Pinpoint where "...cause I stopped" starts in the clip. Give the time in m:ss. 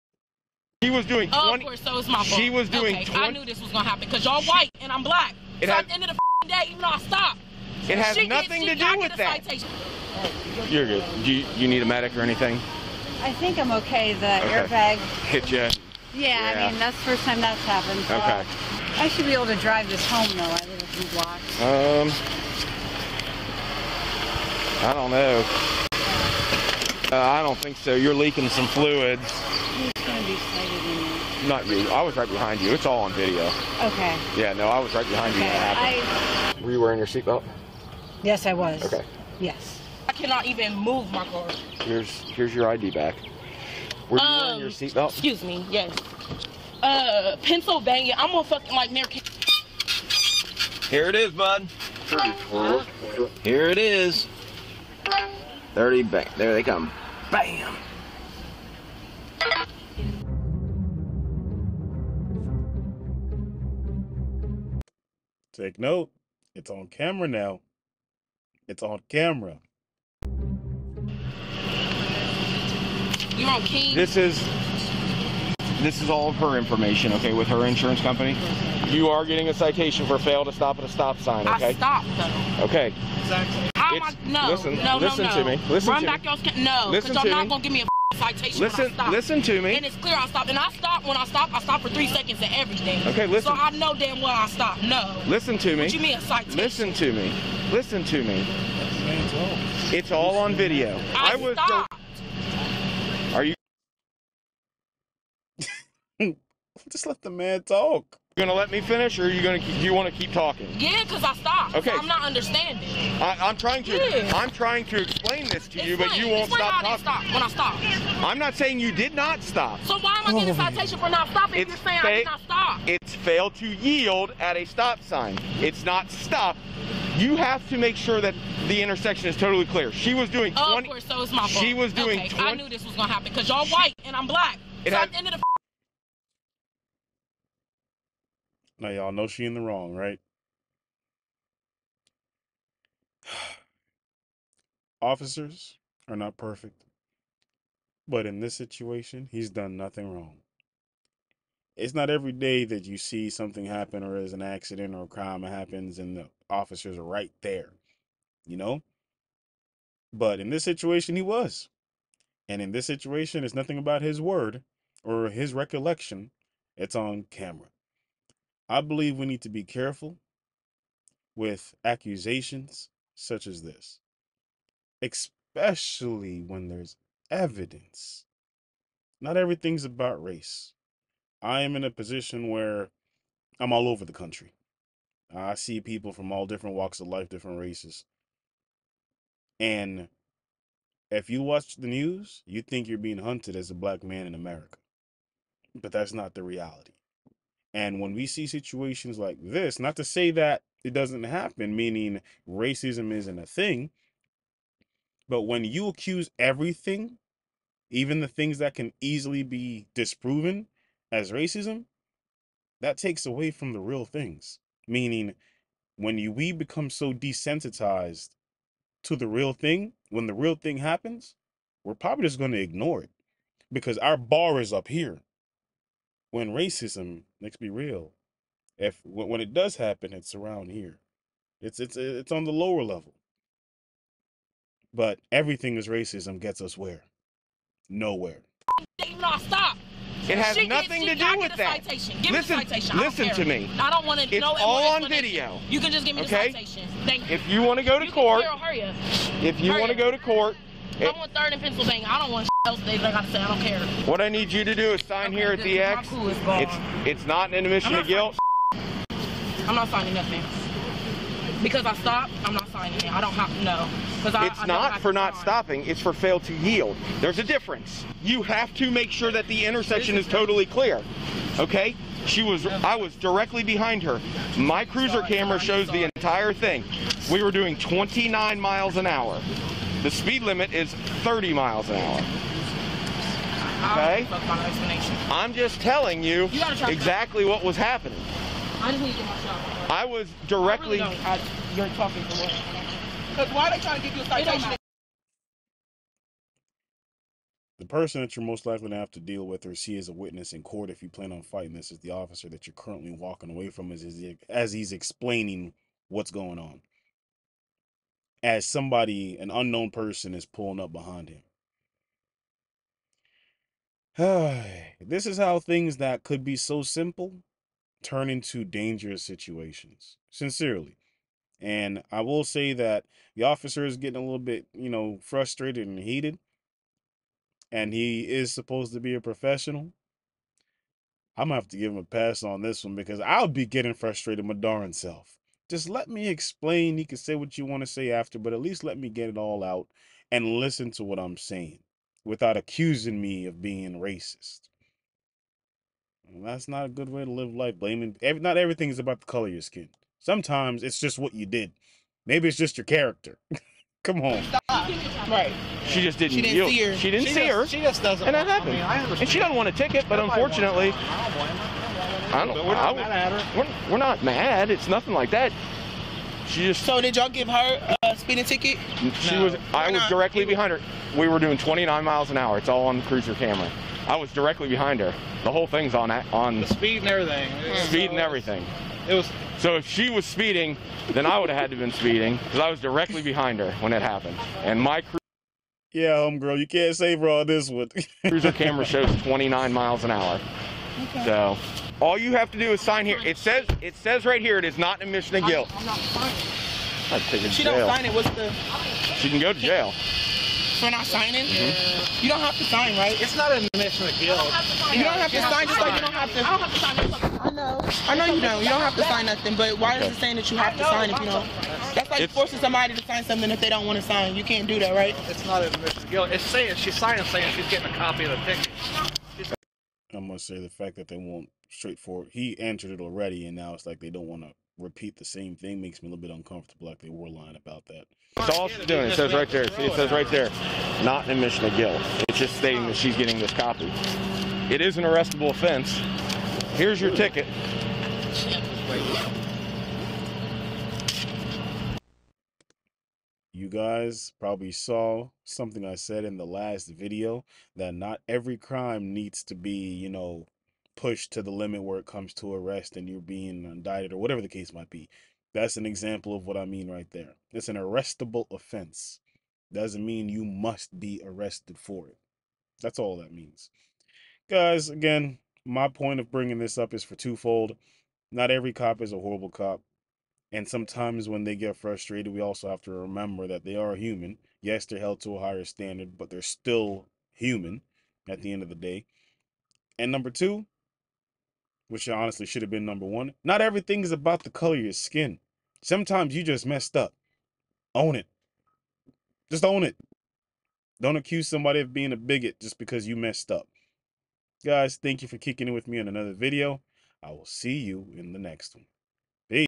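1:51.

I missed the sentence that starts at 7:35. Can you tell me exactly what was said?
That's an example of what I mean right there.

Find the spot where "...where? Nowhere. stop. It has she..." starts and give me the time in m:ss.
3:56.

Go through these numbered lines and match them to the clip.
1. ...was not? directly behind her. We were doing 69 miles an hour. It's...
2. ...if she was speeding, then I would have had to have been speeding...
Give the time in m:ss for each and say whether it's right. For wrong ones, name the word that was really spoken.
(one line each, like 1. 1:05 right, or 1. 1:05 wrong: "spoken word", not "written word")
1. 6:09 wrong: "29", not "69"
2. 6:19 right.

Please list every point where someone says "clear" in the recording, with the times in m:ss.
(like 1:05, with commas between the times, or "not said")
1:29, 2:09, 4:30.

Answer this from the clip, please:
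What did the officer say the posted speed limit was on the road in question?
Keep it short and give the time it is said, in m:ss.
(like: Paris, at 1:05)
30 miles per hour, at 4:40.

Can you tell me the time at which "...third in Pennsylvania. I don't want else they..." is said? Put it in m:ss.
4:11.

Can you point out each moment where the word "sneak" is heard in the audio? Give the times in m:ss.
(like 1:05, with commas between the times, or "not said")
not said.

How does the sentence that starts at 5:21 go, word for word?
And I will say that the officer is getting a little bit, you know, frustrated and heated.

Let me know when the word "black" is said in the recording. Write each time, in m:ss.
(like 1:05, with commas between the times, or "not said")
0:05, 2:14, 3:13.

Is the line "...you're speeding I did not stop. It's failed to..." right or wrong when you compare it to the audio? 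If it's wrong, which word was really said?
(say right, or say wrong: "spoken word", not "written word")
wrong: "saying", not "speeding".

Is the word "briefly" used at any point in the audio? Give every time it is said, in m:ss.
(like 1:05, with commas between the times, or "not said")
not said.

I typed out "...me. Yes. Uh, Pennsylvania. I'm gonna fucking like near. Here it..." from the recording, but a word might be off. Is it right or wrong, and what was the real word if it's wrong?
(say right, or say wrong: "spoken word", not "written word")
right.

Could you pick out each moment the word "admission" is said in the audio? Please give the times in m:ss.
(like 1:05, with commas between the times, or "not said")
4:17, 6:35, 6:43, 6:55, 7:11.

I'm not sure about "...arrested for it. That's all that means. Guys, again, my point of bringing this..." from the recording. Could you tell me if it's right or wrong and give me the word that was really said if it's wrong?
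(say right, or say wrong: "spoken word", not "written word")
right.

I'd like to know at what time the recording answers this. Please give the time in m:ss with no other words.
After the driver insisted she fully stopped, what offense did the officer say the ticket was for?
4:26.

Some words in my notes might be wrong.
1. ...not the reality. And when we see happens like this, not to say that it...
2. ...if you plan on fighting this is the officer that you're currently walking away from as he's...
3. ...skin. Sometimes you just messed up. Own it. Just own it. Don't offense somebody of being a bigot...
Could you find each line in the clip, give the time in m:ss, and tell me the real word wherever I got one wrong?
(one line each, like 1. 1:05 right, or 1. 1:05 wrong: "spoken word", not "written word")
1. 3:16 wrong: "situations", not "happens"
2. 5:00 right
3. 8:04 wrong: "accuse", not "offense".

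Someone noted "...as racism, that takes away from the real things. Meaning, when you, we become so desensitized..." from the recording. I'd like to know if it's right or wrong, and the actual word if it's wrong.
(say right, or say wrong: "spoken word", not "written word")
right.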